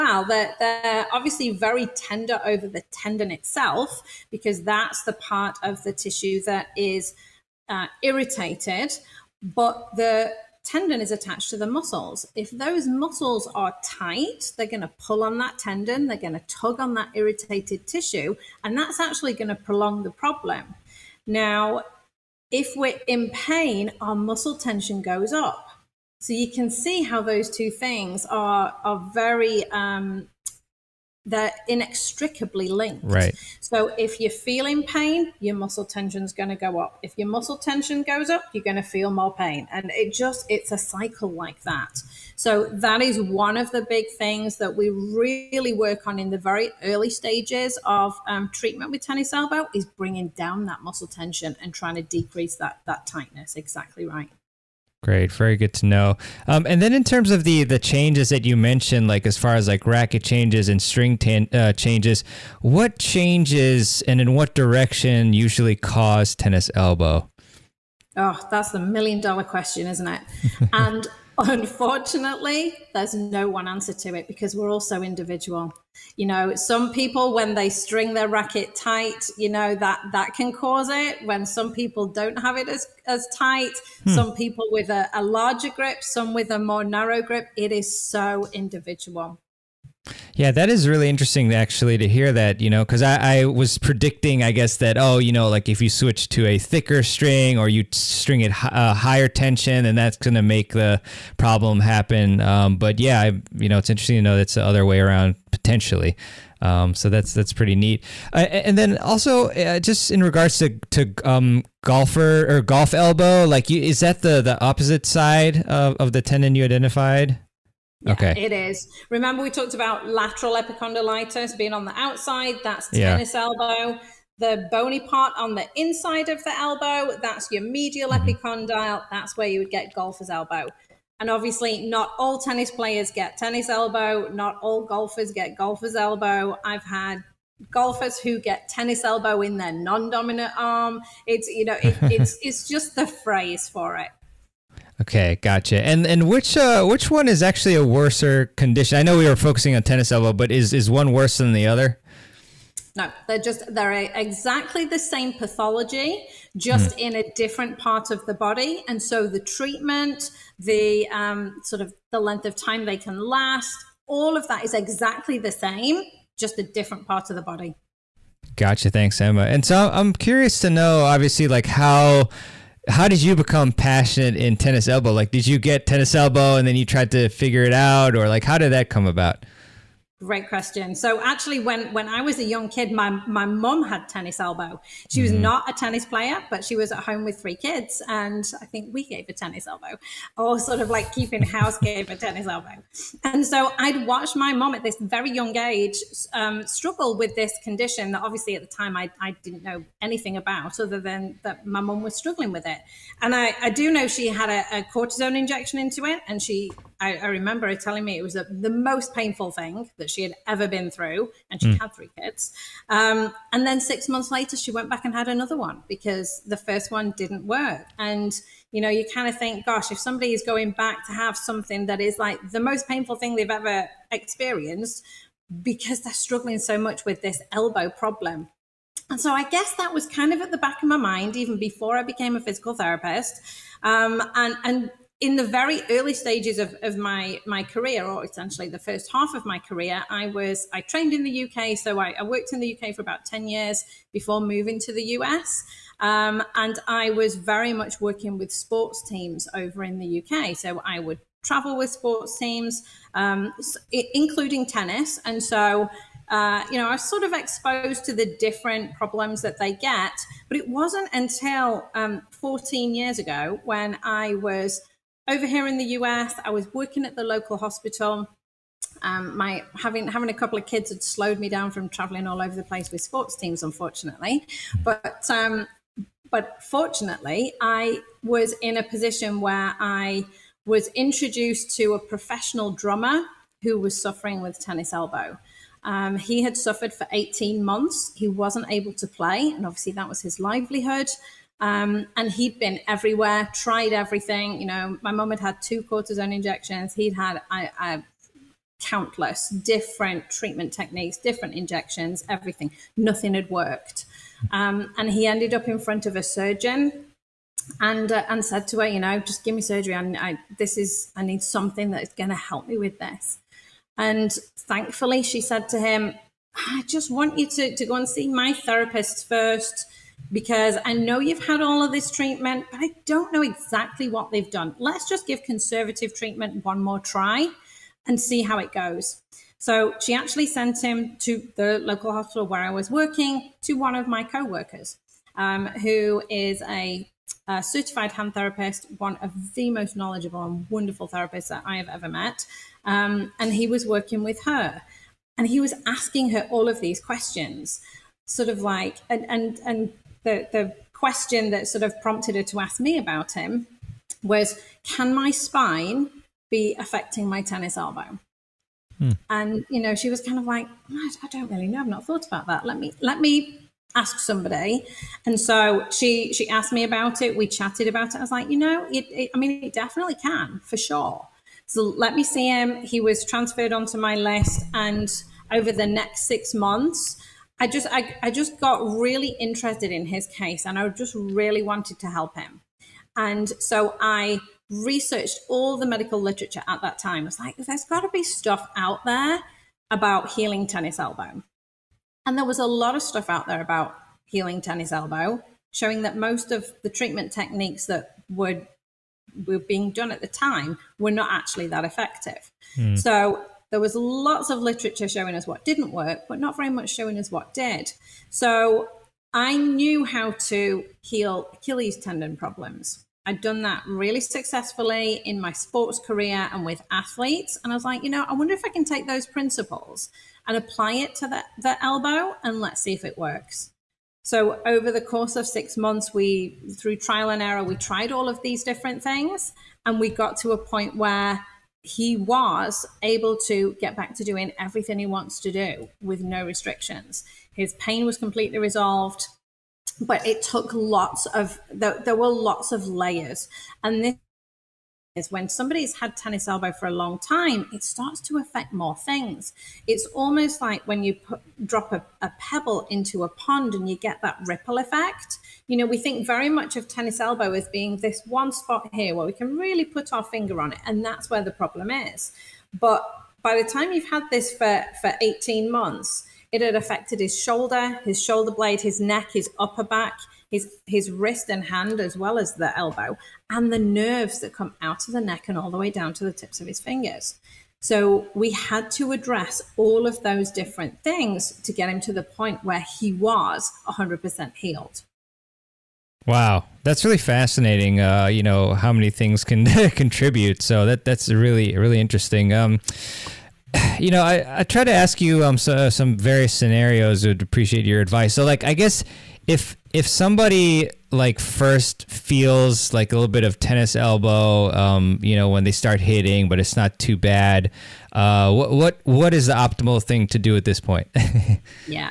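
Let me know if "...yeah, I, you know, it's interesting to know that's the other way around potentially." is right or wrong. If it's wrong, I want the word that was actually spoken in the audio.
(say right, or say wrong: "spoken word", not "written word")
right.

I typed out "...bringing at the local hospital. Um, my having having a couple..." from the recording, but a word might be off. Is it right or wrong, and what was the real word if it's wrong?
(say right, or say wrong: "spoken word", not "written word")
wrong: "working", not "bringing".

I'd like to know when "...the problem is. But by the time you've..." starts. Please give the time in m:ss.
7:41.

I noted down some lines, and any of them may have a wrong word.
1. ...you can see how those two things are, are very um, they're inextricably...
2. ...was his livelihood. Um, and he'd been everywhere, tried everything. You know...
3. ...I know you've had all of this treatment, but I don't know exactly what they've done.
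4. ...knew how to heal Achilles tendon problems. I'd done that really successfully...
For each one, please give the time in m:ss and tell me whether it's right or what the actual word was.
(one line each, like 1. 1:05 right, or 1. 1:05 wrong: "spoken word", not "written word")
1. 0:26 right
2. 4:50 right
3. 5:20 right
4. 6:49 right.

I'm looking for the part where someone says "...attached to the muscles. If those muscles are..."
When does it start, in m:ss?
0:11.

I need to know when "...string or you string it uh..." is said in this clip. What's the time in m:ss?
1:37.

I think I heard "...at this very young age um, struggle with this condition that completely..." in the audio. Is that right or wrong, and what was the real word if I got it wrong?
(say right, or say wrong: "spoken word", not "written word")
wrong: "obviously", not "completely".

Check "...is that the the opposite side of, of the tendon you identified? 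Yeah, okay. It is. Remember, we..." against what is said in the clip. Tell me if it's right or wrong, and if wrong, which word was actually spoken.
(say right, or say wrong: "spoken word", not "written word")
right.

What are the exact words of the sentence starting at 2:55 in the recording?
Like, did you get tennis elbow and then you tried to figure it out, or like, how did that come about?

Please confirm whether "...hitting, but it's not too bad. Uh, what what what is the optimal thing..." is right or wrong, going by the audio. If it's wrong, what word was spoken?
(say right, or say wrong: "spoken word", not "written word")
right.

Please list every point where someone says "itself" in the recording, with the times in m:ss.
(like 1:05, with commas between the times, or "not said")
0:03.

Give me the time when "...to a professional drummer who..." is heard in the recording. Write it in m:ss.
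4:41.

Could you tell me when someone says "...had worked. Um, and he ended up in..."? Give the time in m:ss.
5:03.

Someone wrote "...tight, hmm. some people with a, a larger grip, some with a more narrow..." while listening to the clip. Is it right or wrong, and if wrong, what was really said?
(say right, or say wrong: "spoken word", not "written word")
right.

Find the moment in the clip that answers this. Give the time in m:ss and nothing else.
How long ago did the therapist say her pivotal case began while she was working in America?
4:22.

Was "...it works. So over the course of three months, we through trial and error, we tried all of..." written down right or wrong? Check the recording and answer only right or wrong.
wrong.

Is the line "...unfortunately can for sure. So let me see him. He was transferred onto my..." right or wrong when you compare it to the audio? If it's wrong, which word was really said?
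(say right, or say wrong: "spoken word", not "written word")
wrong: "definitely", not "unfortunately".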